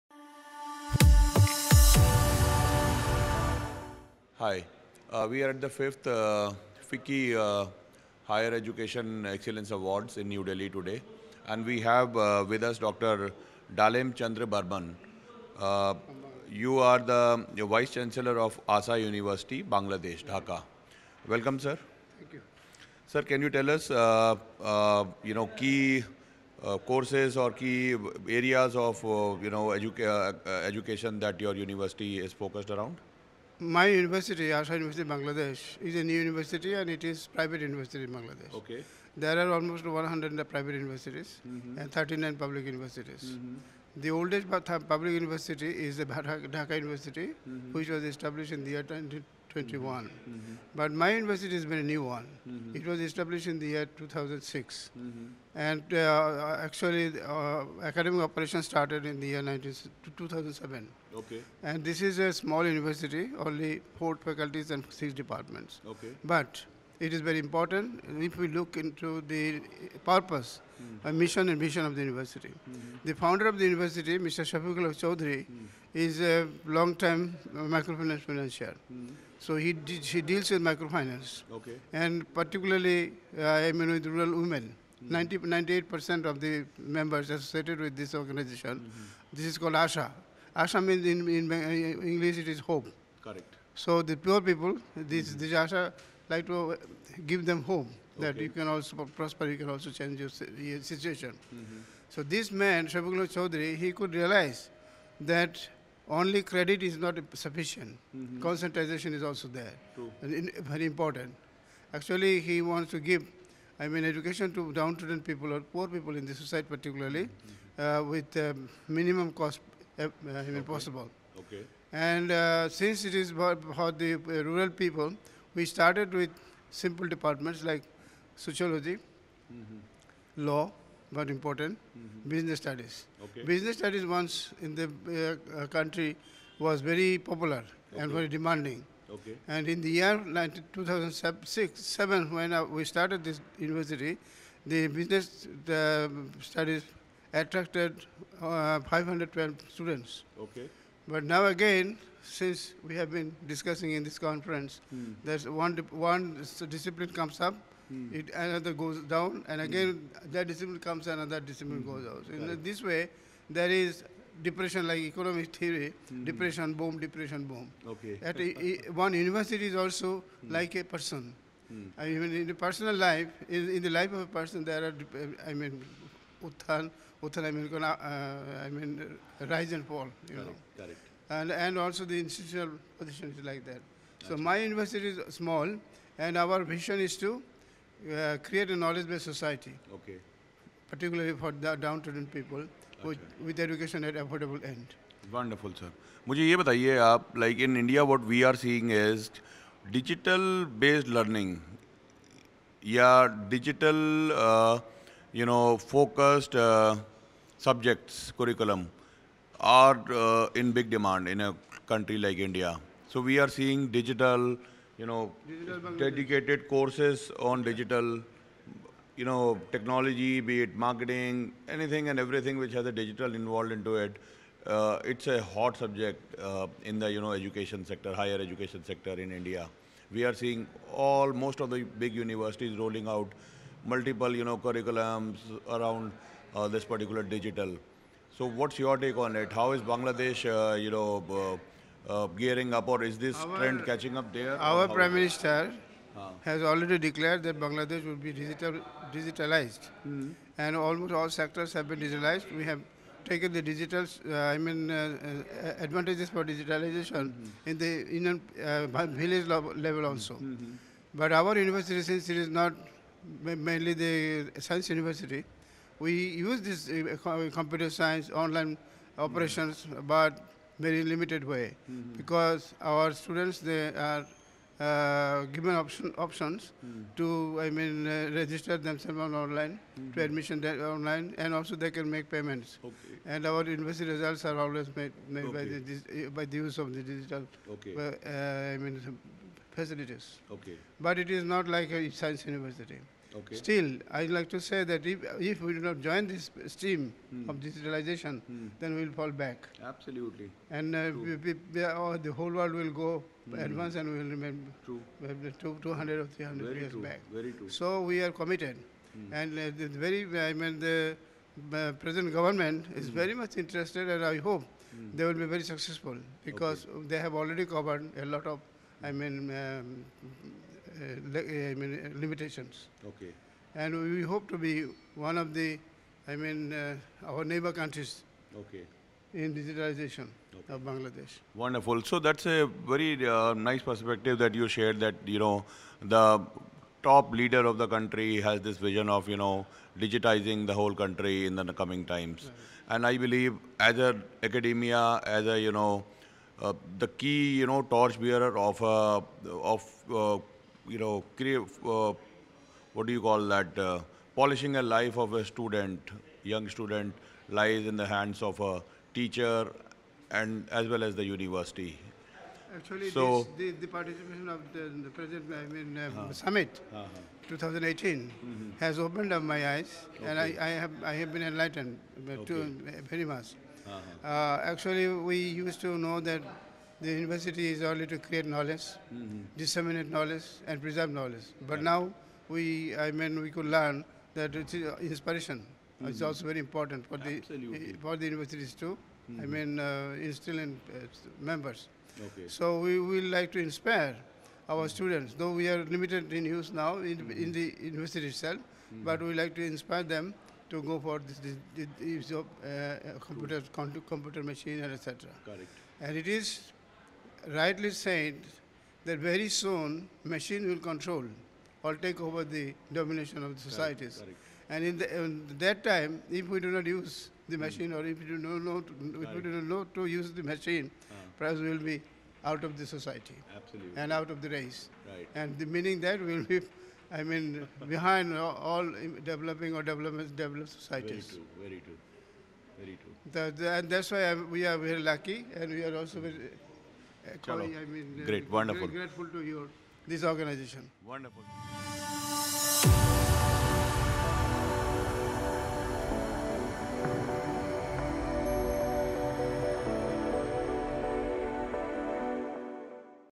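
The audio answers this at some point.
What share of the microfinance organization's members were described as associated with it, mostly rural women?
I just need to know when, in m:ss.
1:25.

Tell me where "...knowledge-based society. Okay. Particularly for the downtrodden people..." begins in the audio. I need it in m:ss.
3:08.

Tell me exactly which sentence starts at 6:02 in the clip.
Actually, so, this, the, the, participation of the, the present I mean, uh, uh-huh.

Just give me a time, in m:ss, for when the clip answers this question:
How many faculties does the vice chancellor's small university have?
1:03.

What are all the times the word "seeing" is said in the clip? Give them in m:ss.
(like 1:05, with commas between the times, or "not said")
3:18, 3:33, 3:50.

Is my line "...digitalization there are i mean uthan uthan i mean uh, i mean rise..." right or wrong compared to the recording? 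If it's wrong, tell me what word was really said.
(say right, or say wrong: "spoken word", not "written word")
wrong: "person", not "digitalization".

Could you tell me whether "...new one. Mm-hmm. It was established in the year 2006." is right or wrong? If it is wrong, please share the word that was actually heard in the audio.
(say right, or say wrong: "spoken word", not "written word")
right.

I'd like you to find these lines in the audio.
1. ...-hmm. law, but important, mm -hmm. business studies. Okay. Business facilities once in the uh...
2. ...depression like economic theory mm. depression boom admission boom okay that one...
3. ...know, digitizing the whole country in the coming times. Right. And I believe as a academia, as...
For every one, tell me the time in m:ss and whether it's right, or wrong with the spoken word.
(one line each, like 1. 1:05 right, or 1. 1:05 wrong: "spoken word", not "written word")
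1. 2:09 wrong: "studies", not "facilities"
2. 2:44 wrong: "depression", not "admission"
3. 5:39 right.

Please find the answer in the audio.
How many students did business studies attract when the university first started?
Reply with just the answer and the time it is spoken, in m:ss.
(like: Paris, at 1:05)
512, at 2:28.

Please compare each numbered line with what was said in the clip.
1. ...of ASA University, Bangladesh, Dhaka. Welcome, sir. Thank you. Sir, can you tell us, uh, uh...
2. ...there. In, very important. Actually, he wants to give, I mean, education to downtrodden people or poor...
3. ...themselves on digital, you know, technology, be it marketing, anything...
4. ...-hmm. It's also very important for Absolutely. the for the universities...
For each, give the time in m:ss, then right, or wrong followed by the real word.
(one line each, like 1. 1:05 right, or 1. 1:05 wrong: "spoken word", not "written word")
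1. 0:18 right
2. 1:49 right
3. 3:36 wrong: "courses", not "themselves"
4. 6:25 right.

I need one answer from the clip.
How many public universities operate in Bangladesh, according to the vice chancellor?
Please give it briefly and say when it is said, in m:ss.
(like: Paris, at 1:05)
39, at 0:41.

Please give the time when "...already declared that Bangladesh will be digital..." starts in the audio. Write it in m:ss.
4:06.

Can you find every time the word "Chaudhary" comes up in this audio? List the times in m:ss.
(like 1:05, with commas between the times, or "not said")
1:15, 1:43.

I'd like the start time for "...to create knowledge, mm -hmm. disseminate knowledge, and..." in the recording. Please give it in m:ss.
6:18.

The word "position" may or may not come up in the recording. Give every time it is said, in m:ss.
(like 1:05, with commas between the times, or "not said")
3:02.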